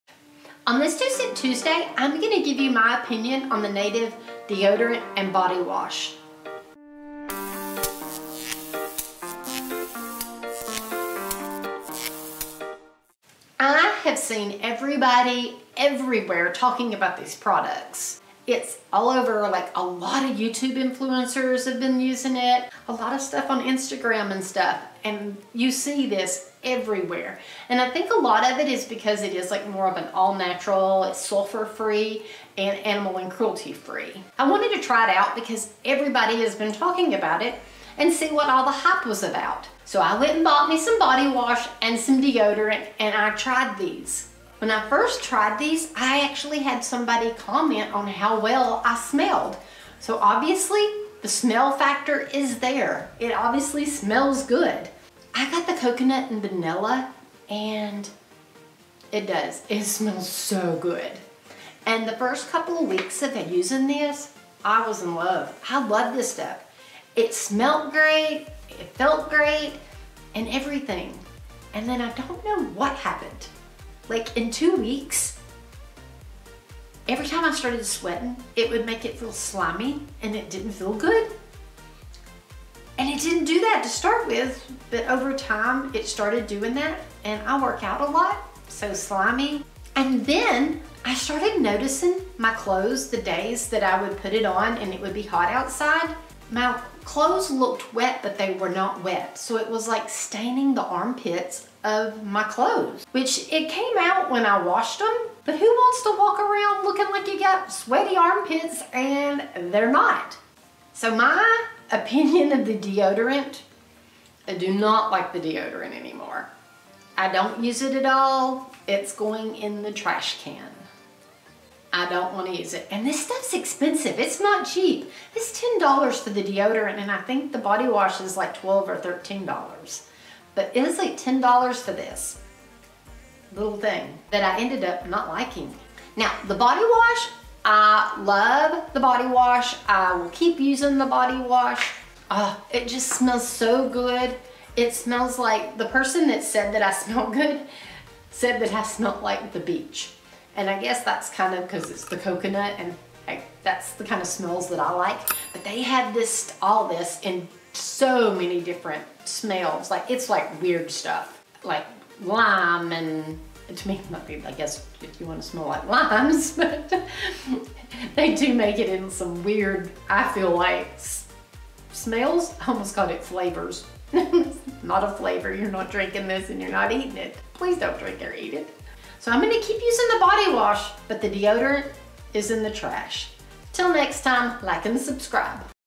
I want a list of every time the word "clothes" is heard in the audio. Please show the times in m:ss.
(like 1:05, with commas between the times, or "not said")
1:32, 1:37, 1:42.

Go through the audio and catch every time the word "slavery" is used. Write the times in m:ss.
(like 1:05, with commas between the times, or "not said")
not said.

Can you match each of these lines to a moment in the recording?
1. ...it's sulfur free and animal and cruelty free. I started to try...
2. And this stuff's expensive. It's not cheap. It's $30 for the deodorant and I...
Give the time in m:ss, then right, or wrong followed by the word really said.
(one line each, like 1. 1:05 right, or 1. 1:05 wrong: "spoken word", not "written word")
1. 0:31 wrong: "wanted", not "started"
2. 2:02 wrong: "10", not "30".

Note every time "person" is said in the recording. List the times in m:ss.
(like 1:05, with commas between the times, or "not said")
2:25.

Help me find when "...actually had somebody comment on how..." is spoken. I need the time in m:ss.
0:46.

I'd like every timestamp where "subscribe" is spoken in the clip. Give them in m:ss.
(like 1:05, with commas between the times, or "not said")
3:04.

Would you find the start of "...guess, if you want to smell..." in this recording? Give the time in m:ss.
2:44.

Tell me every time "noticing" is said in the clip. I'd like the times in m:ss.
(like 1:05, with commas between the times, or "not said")
1:31.